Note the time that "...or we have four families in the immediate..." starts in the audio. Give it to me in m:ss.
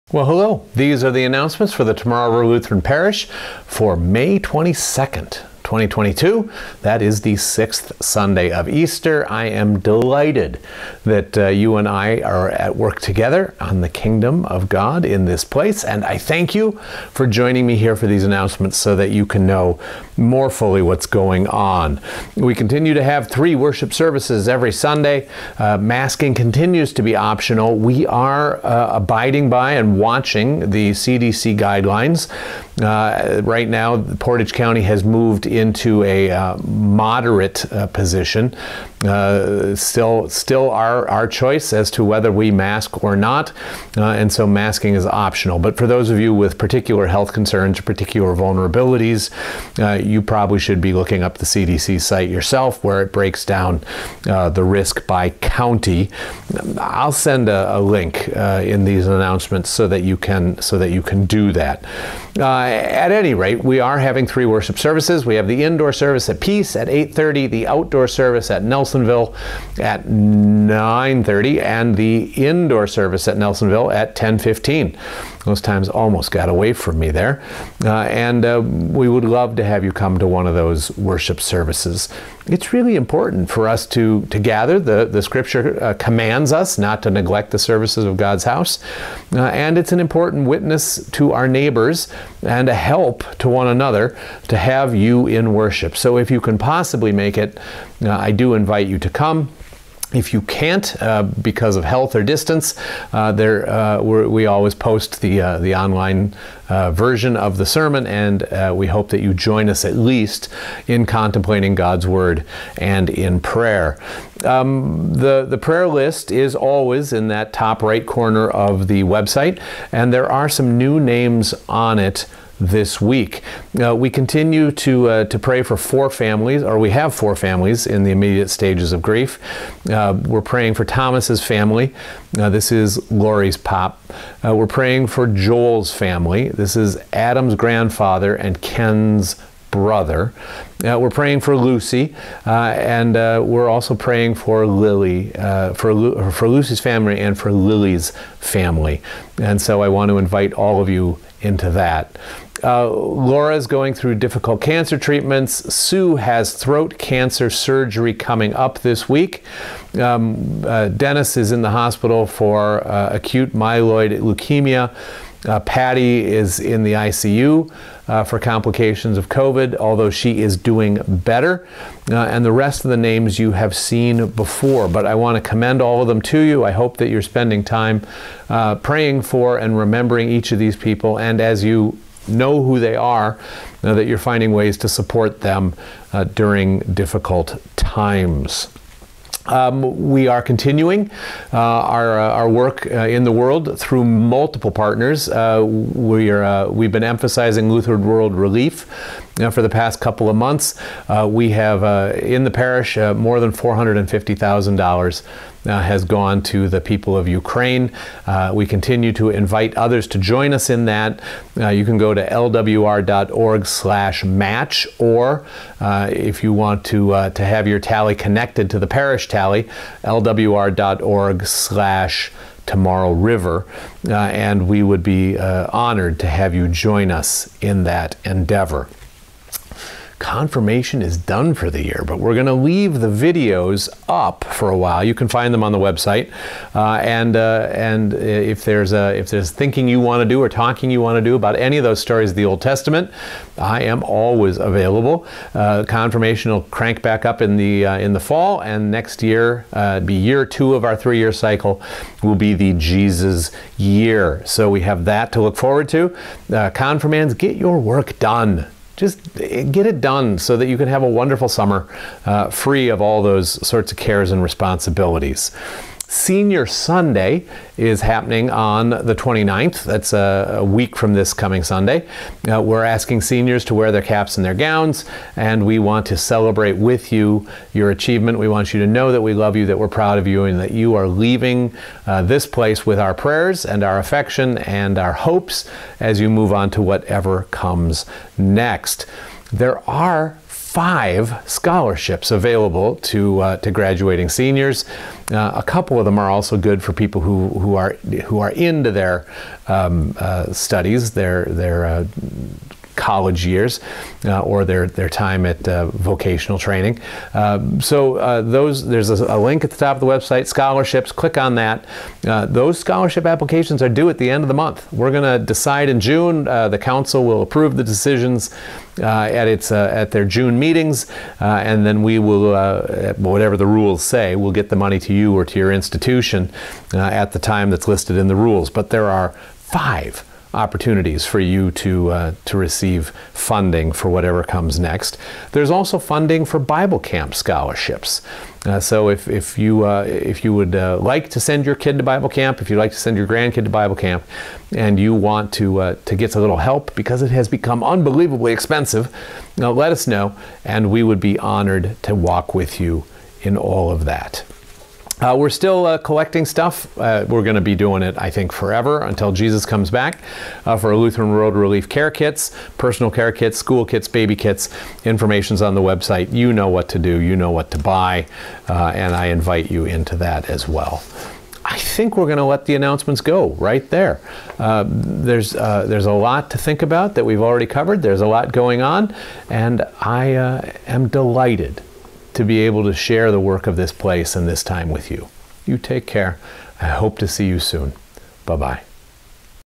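2:06.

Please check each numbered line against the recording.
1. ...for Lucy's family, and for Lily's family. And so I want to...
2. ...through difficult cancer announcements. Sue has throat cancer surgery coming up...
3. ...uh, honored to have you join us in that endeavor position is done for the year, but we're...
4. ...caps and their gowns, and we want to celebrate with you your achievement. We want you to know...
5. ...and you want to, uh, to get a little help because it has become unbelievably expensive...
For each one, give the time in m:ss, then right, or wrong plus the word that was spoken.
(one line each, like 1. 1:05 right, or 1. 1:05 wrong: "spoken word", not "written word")
1. 2:26 right
2. 2:33 wrong: "treatments", not "announcements"
3. 3:45 wrong: "confirmation", not "position"
4. 4:34 right
5. 5:44 right.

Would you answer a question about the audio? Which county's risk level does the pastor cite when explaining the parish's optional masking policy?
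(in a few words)
Portage County.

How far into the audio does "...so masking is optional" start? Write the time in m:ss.
0:44.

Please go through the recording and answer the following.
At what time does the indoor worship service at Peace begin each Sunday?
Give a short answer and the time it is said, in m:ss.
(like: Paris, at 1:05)
8:30, at 1:06.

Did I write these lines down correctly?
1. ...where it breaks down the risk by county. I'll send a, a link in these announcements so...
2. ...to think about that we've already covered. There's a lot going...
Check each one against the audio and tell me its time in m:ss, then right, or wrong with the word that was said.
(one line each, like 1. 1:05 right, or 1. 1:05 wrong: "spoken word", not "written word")
1. 0:52 right
2. 6:16 right.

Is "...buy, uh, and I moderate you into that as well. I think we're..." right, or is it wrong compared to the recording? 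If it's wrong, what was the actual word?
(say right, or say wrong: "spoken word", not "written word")
wrong: "invite", not "moderate".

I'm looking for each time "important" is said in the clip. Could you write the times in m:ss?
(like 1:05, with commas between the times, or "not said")
1:22, 1:29.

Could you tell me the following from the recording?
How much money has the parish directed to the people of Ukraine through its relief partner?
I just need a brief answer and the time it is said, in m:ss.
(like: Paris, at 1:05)
$450,000, at 3:23.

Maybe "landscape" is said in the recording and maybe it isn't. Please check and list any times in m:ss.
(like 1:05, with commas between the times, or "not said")
not said.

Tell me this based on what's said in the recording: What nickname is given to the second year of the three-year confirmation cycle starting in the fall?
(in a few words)
the Jesus year.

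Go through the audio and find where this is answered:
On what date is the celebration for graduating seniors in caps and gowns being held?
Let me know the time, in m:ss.
4:29.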